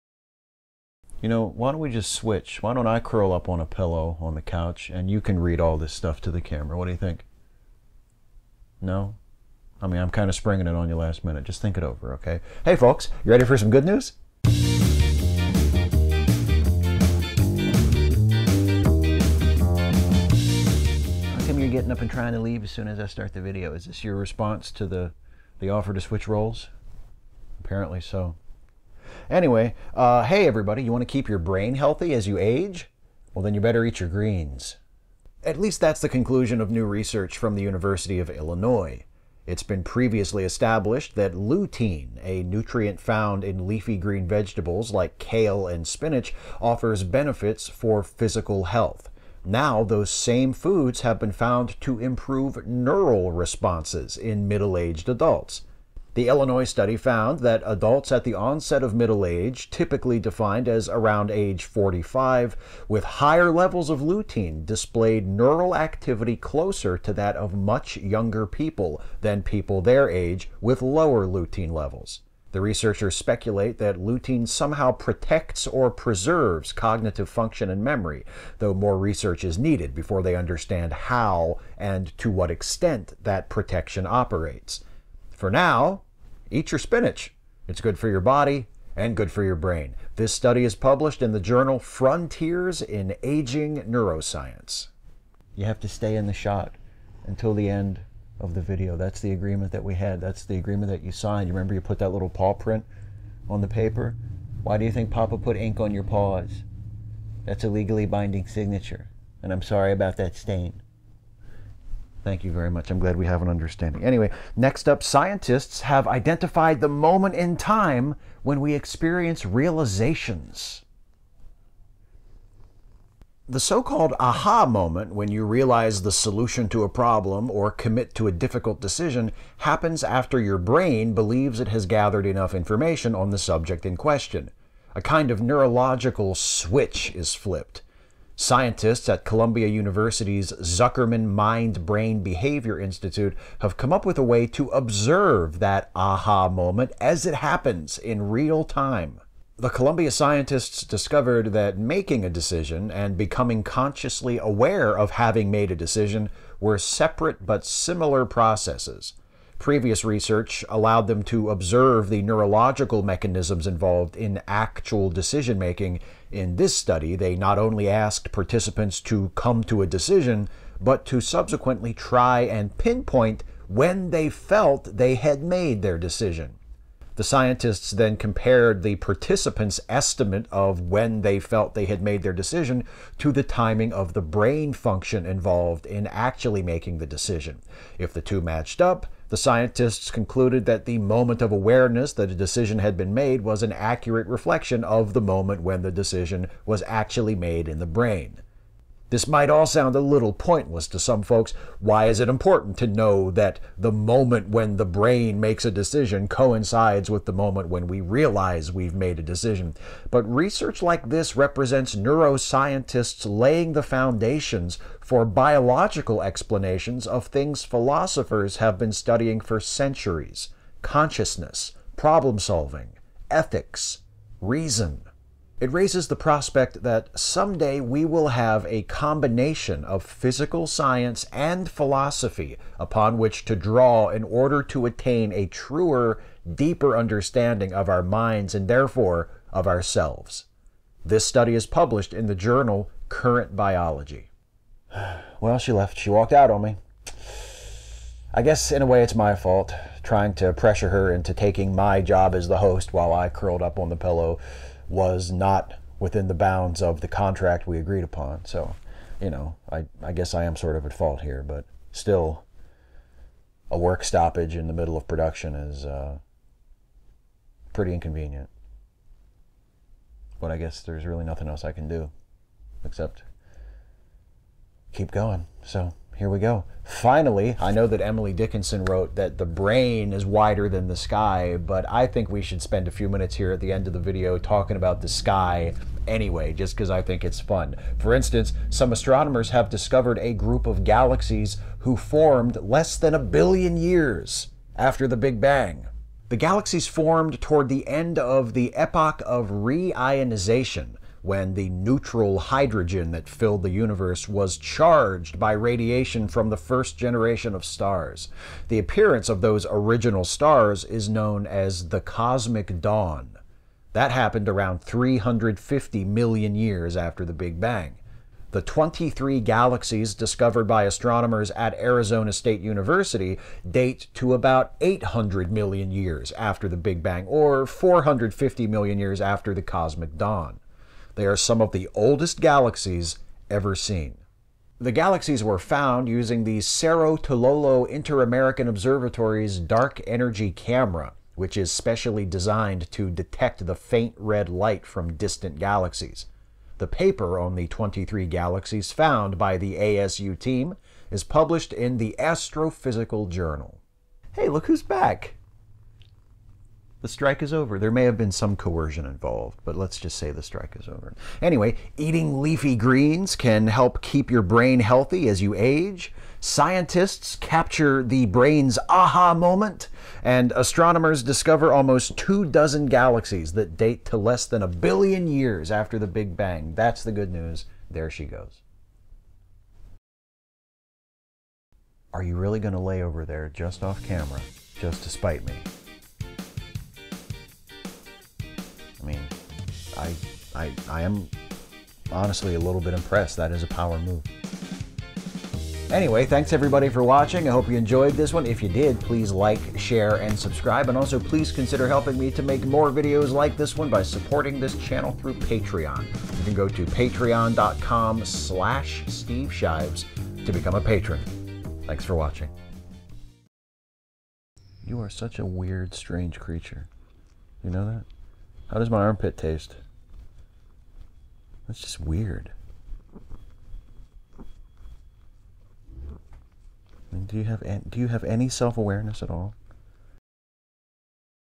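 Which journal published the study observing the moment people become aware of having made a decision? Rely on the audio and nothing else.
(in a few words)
Current Biology.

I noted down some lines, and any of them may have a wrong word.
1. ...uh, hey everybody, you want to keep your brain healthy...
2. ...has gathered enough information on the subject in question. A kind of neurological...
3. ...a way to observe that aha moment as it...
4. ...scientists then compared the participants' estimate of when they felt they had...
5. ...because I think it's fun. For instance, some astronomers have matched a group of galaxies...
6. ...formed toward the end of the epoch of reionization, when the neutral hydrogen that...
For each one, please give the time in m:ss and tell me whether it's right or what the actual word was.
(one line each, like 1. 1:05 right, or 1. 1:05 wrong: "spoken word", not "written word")
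1. 0:29 right
2. 2:11 right
3. 2:24 right
4. 2:57 right
5. 4:46 wrong: "discovered", not "matched"
6. 4:56 right.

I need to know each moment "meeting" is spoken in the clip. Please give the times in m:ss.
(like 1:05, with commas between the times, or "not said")
not said.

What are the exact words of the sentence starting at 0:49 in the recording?
Now, those same foods have been found to improve neural responses in middle aged adults.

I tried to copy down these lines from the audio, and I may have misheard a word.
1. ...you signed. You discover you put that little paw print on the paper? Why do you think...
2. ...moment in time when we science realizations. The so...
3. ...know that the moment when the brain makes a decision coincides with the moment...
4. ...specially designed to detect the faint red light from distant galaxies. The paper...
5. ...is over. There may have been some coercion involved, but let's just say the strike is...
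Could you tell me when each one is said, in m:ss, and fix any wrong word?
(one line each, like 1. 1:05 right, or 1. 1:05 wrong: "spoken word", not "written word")
1. 1:41 wrong: "remember", not "discover"
2. 1:56 wrong: "experience", not "science"
3. 3:22 right
4. 5:41 right
5. 5:57 right.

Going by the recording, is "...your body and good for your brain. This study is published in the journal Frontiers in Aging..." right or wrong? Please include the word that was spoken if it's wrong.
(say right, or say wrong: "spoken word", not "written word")
right.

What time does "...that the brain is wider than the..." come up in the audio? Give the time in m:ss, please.
4:39.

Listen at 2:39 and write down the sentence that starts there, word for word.
Previous research allowed them to observe the neurological mechanisms involved in actual decision making.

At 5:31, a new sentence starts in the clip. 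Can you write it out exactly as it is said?
They are some of the oldest galaxies ever seen.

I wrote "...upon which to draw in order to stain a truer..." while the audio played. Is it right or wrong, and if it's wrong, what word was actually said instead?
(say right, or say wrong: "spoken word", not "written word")
wrong: "attain", not "stain".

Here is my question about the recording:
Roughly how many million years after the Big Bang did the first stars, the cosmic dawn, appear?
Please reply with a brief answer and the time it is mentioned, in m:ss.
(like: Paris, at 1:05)
350 million years, at 5:14.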